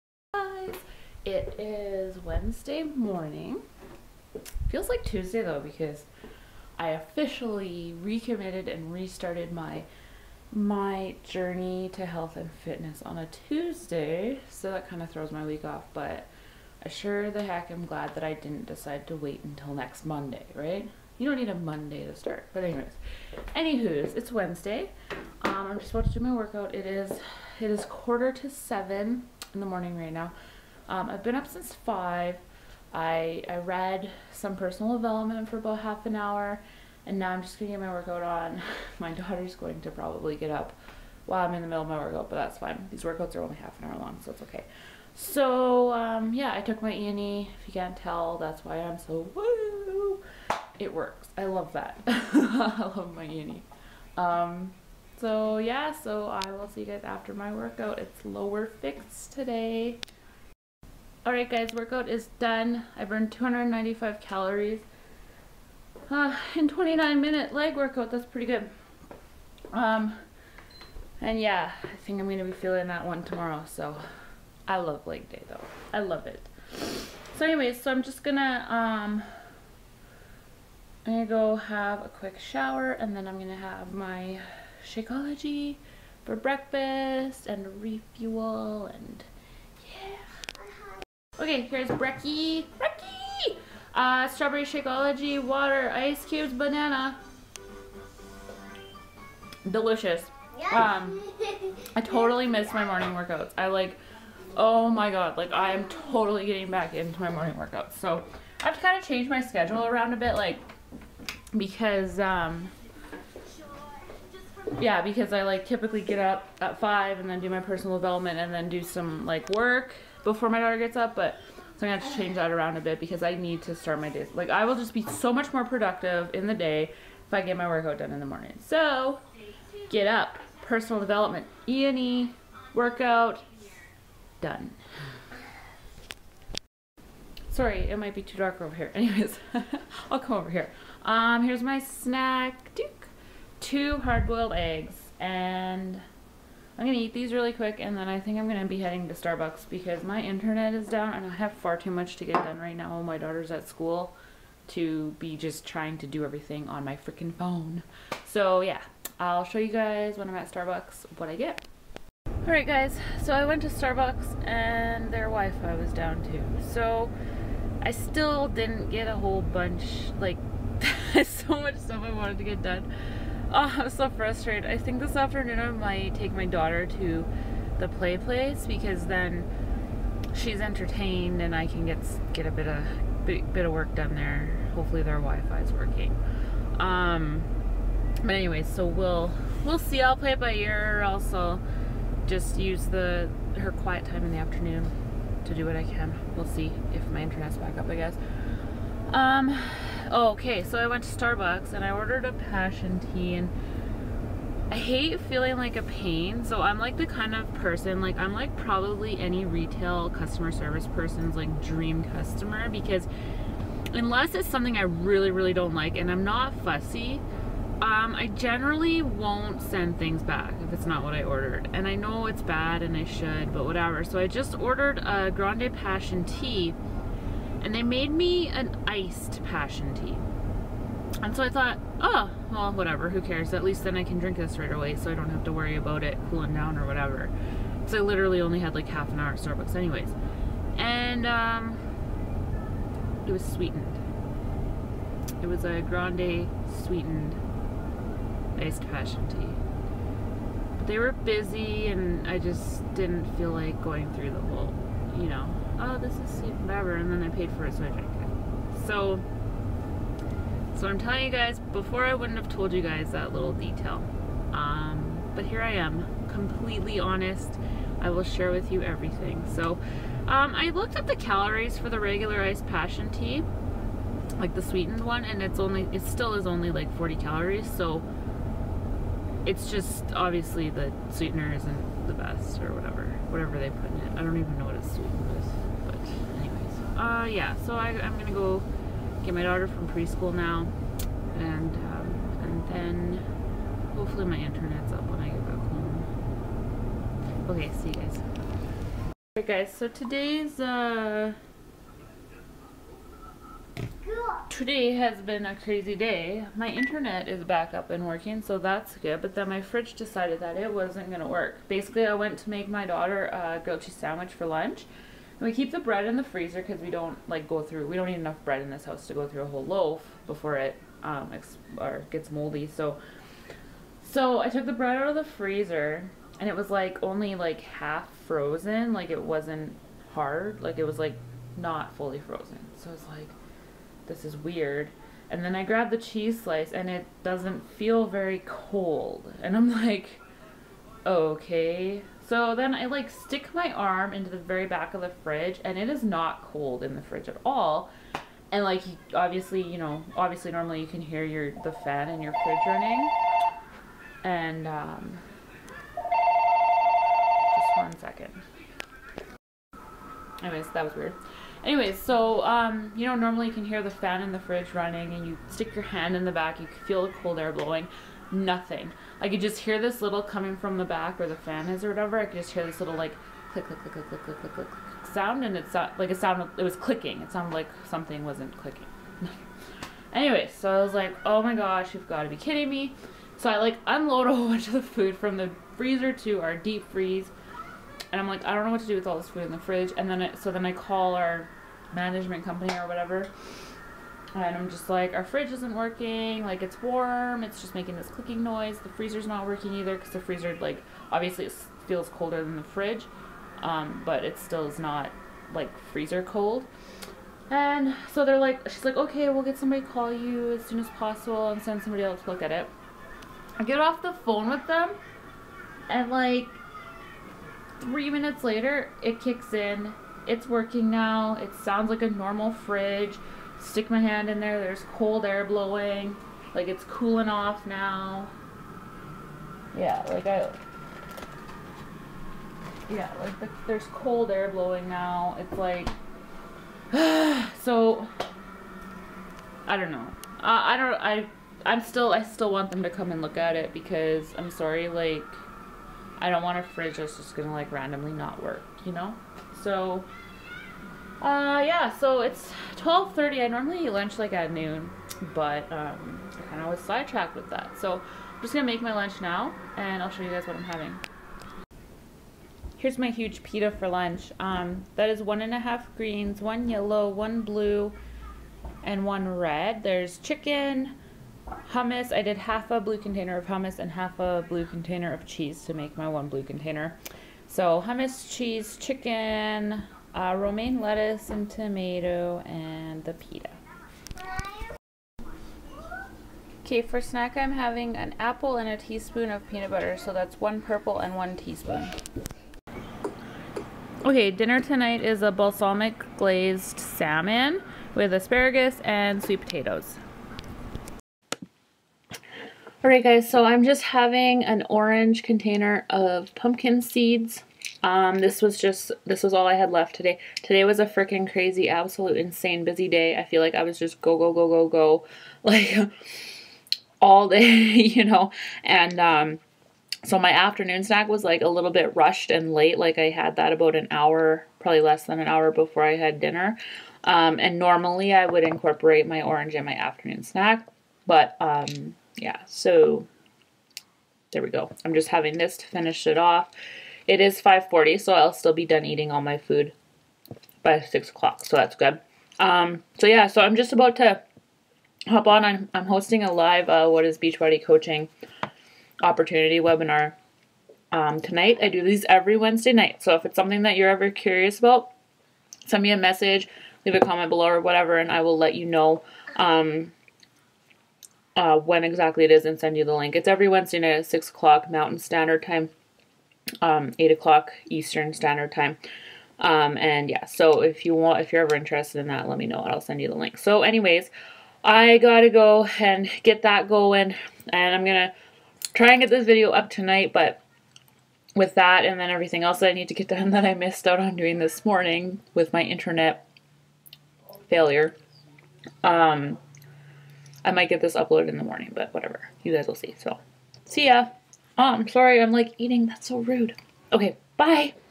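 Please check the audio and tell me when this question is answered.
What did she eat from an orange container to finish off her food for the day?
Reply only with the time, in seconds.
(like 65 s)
506 s.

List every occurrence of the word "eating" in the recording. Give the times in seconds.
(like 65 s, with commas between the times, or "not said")
538 s, 595 s.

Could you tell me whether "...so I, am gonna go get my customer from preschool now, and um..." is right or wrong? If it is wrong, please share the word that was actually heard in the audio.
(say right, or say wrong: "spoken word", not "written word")
wrong: "daughter", not "customer".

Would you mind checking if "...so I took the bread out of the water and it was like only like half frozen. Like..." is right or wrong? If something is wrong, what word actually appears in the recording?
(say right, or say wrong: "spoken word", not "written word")
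wrong: "freezer", not "water".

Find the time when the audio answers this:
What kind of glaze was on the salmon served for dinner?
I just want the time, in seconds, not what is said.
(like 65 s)
495 s.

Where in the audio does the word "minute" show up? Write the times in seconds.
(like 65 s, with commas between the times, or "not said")
67 s, 418 s.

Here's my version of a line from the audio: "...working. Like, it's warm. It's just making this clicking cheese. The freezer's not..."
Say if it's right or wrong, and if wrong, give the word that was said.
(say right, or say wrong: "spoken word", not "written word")
wrong: "noise", not "cheese".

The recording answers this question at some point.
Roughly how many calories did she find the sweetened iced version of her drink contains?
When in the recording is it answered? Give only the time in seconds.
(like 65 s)
276 s.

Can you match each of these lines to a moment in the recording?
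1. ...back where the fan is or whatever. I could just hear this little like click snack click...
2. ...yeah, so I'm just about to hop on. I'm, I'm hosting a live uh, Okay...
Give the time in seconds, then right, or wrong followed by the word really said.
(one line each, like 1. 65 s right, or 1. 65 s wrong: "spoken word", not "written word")
1. 370 s wrong: "click", not "snack"
2. 543 s wrong: "What", not "Okay".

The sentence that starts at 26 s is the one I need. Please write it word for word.
It is it is quarter to seven in the morning right now.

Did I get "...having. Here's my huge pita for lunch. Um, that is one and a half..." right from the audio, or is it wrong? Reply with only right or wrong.
right.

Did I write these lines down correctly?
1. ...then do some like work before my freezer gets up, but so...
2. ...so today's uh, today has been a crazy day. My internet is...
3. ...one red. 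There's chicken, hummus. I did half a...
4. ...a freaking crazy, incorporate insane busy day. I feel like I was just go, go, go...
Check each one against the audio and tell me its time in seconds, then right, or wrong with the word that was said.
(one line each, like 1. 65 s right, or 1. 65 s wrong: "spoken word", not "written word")
1. 118 s wrong: "daughter", not "freezer"
2. 299 s right
3. 469 s right
4. 510 s wrong: "absolute", not "incorporate".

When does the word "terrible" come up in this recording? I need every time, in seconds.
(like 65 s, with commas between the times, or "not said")
not said.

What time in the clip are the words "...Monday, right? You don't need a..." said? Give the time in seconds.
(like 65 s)
20 s.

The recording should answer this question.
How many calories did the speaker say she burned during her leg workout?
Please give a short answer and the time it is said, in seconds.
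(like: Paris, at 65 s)
295, at 63 s.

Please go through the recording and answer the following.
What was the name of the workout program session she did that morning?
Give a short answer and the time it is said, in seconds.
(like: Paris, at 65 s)
Lower Fix, at 58 s.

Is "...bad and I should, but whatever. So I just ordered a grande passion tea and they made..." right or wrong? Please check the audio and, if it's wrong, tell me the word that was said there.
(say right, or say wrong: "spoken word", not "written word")
right.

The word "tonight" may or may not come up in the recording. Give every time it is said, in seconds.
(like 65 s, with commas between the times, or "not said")
494 s, 551 s, 579 s.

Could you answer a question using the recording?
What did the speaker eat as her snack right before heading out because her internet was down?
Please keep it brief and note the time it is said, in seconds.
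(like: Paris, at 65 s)
Two hard-boiled eggs, at 143 s.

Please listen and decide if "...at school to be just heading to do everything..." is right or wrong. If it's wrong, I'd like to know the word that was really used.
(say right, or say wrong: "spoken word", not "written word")
wrong: "trying", not "heading".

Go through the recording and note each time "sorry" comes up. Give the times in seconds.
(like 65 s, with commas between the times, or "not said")
137 s, 444 s, 594 s.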